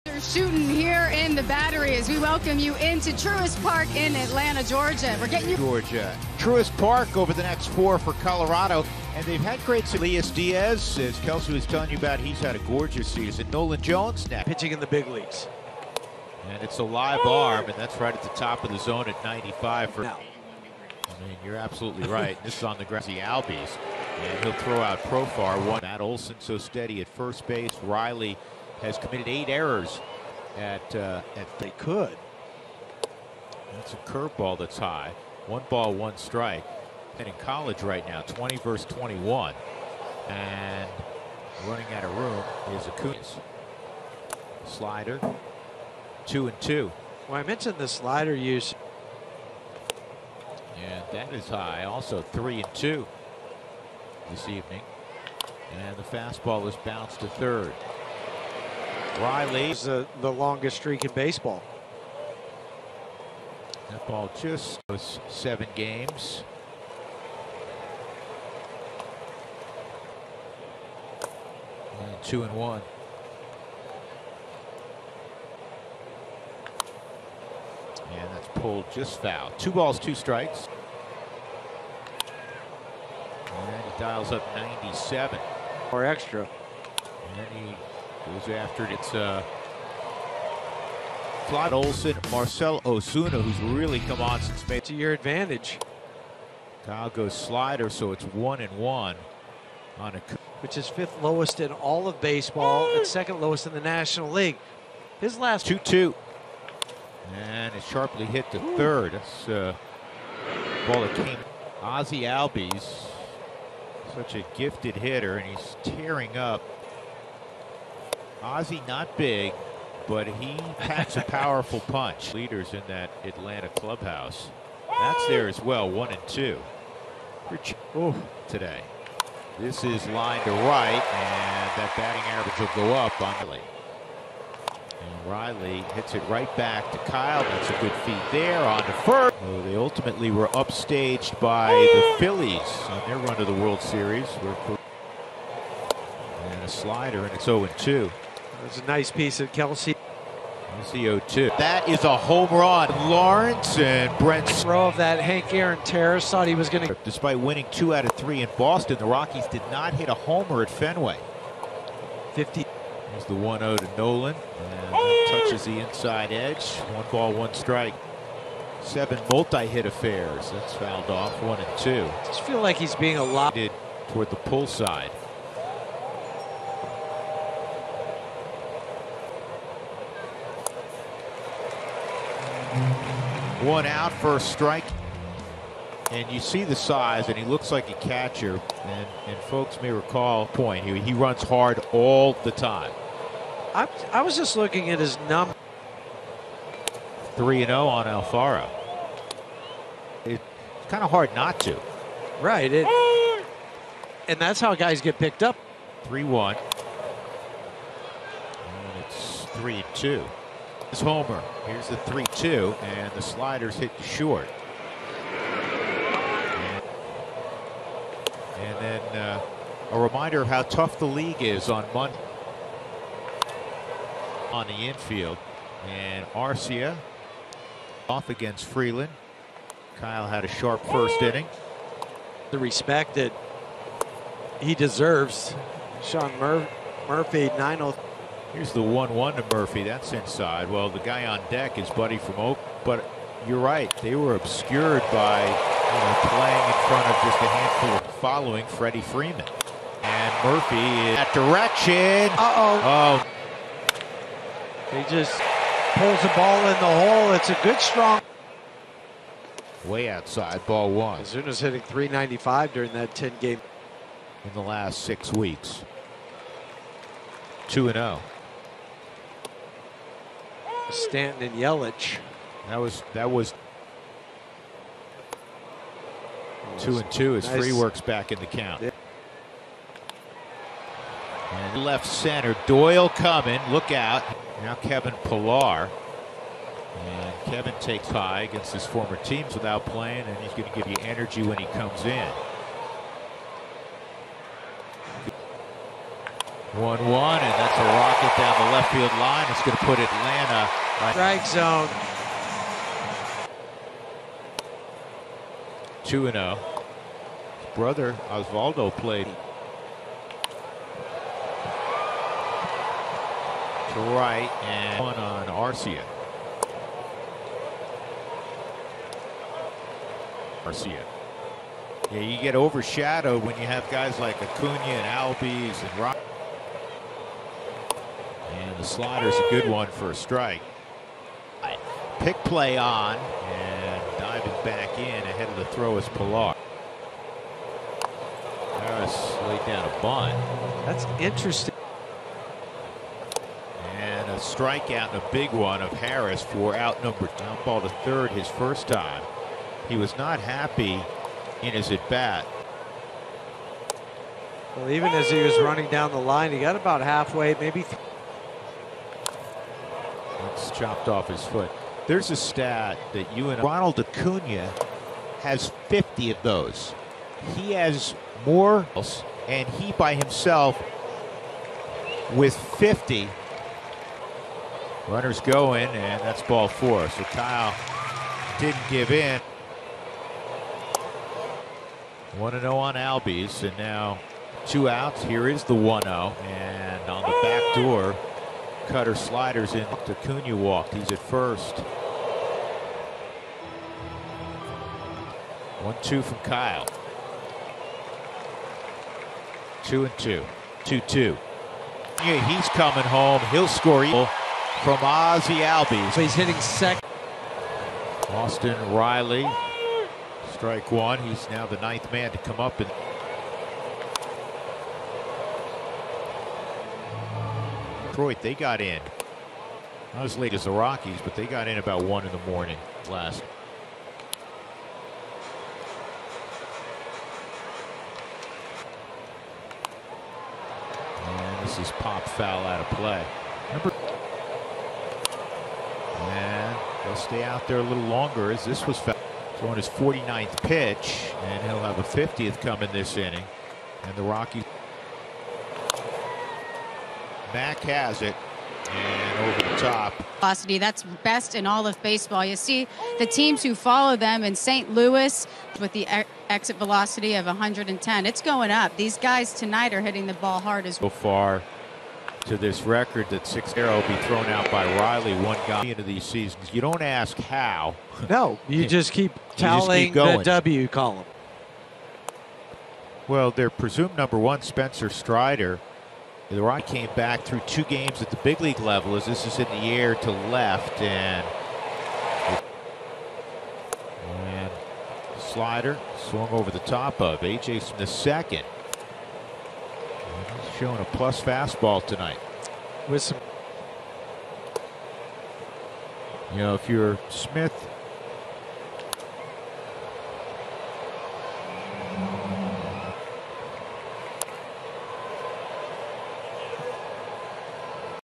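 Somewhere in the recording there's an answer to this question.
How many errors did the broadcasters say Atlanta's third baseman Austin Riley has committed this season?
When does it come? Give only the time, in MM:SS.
00:29.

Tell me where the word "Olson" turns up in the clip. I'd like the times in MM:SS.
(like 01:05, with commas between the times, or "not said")
00:25, 01:31.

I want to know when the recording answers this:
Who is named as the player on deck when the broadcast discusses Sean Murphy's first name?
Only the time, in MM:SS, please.
04:01.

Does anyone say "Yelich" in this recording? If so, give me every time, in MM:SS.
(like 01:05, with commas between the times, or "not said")
04:31.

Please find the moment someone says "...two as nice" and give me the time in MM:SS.
04:37.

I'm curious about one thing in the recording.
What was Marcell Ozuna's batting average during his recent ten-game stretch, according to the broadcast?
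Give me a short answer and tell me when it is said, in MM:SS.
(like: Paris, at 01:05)
.395, at 04:21.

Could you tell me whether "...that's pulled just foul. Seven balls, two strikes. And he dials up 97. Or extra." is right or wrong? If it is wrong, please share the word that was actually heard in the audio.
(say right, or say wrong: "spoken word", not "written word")
wrong: "Two", not "Seven".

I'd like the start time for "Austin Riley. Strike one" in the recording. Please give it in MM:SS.
06:48.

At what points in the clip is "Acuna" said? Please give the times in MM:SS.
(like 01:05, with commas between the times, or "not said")
00:42, 05:24, 06:03, 06:29.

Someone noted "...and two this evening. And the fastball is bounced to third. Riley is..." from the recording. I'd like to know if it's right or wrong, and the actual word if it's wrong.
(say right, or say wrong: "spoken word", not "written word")
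right.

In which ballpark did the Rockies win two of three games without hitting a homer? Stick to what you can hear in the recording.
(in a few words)
Fenway.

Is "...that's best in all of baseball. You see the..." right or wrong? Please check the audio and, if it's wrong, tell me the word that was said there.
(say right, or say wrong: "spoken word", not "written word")
right.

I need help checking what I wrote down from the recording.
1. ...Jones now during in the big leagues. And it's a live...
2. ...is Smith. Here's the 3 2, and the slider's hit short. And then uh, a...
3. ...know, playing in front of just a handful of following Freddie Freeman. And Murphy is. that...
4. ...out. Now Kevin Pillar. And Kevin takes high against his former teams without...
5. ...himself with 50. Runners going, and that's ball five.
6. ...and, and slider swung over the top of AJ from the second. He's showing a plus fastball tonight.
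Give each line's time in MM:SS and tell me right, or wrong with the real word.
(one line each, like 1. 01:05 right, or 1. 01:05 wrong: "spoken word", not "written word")
1. 00:13 wrong: "pitching", not "during"
2. 03:30 wrong: "Homer", not "Smith"
3. 04:05 right
4. 04:43 right
5. 06:10 wrong: "four", not "five"
6. 08:01 right.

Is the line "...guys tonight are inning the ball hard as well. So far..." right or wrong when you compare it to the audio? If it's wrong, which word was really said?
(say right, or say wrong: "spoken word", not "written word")
wrong: "hitting", not "inning".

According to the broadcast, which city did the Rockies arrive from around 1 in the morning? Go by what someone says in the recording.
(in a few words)
Detroit.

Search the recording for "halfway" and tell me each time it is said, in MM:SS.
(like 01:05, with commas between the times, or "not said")
05:57.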